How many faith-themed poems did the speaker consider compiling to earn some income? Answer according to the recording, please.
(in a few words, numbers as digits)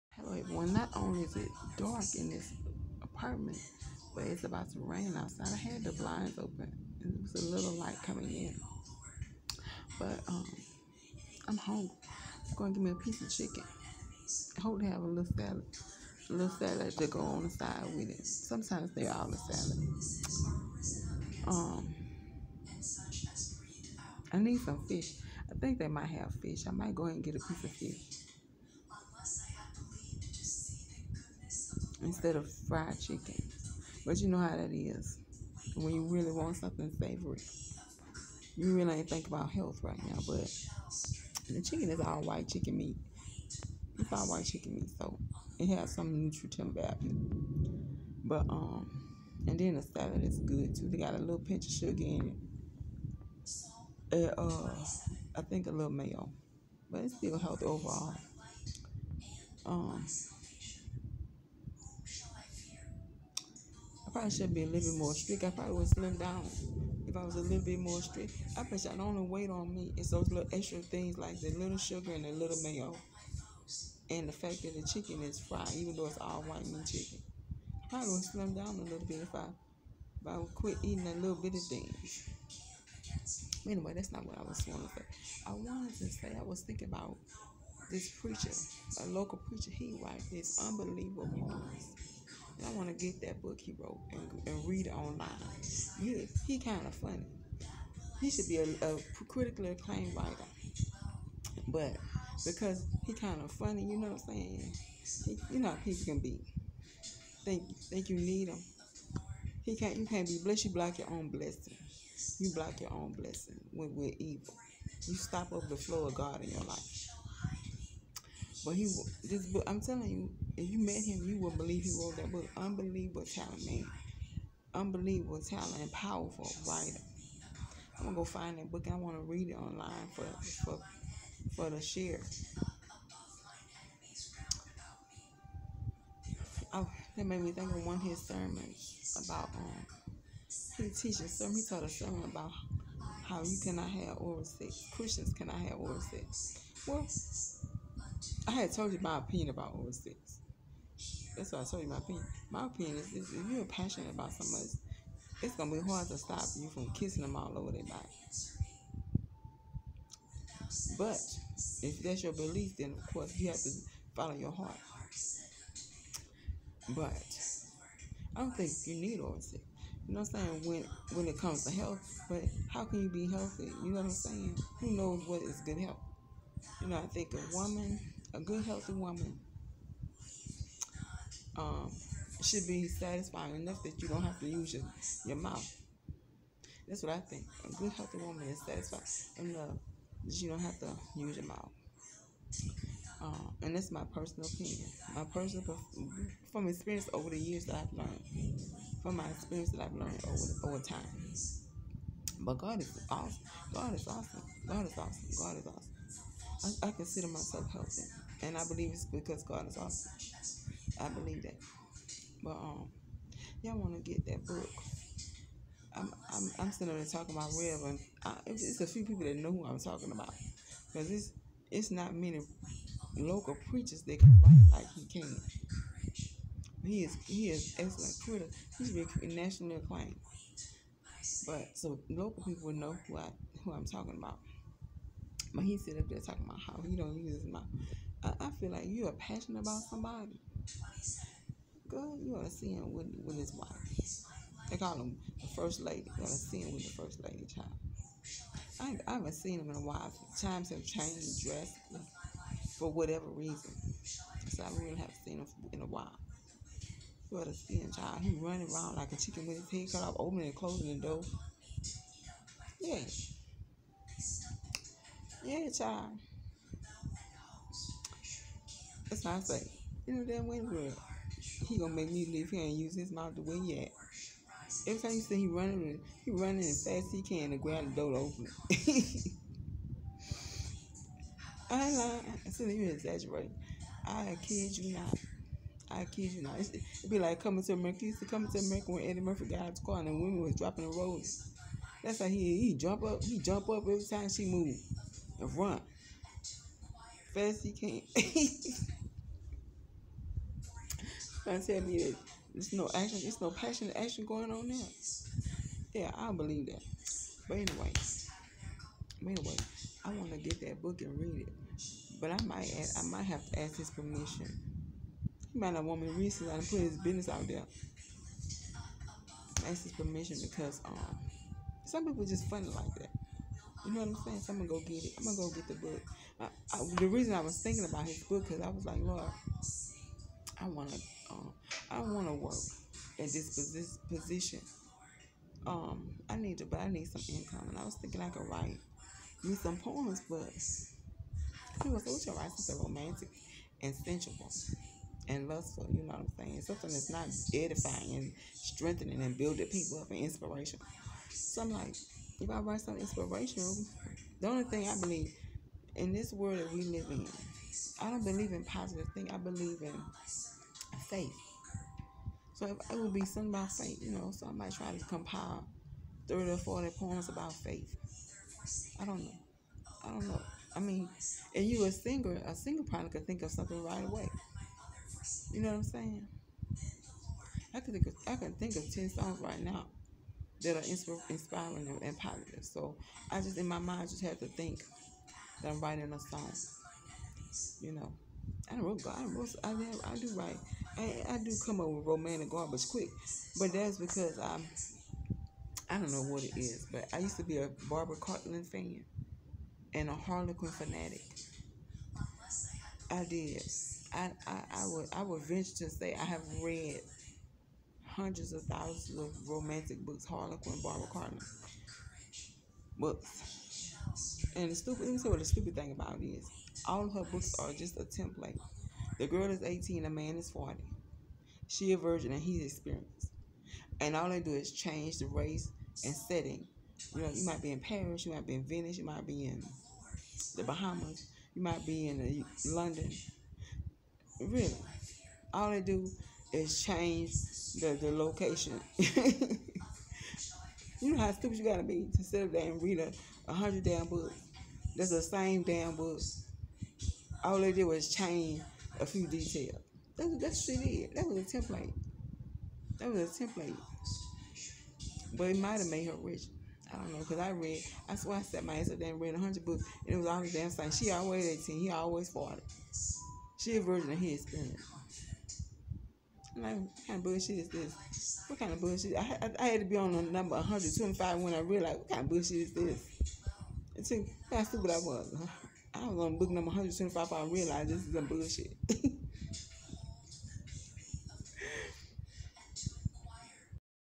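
30 or 40.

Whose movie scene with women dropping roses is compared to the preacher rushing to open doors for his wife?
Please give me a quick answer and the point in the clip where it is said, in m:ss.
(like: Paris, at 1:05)
Eddie Murphy, at 4:49.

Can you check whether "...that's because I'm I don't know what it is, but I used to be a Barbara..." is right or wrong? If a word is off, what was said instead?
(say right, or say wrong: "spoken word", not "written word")
right.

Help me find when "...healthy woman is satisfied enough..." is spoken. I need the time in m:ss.
3:07.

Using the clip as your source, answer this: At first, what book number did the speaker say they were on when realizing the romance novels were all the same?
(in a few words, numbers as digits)
125.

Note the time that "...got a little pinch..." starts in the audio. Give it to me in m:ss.
0:50.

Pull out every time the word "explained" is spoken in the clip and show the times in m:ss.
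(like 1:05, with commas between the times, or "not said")
not said.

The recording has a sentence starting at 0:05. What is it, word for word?
I had the blinds open, and it was a little light coming in.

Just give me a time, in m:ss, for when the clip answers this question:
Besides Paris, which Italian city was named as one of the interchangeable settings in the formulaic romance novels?
7:08.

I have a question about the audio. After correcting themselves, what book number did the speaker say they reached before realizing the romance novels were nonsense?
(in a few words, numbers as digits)
175.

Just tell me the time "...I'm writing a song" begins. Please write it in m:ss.
6:25.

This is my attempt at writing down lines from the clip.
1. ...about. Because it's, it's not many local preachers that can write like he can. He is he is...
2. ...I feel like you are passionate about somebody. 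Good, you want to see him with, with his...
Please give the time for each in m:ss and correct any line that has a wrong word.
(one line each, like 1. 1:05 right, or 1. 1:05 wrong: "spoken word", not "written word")
1. 3:40 right
2. 3:58 right.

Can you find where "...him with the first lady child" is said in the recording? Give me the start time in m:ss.
4:06.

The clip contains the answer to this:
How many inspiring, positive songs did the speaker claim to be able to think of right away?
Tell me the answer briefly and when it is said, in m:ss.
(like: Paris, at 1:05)
10, at 6:18.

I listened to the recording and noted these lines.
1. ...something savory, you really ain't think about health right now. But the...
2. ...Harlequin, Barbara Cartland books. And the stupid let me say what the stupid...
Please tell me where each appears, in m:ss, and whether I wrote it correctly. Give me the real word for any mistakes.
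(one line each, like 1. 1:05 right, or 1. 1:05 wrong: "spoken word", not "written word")
1. 0:36 right
2. 6:50 right.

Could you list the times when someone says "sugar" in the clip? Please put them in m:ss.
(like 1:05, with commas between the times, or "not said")
0:51, 1:11.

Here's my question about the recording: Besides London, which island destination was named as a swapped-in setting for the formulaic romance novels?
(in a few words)
the Bahamas.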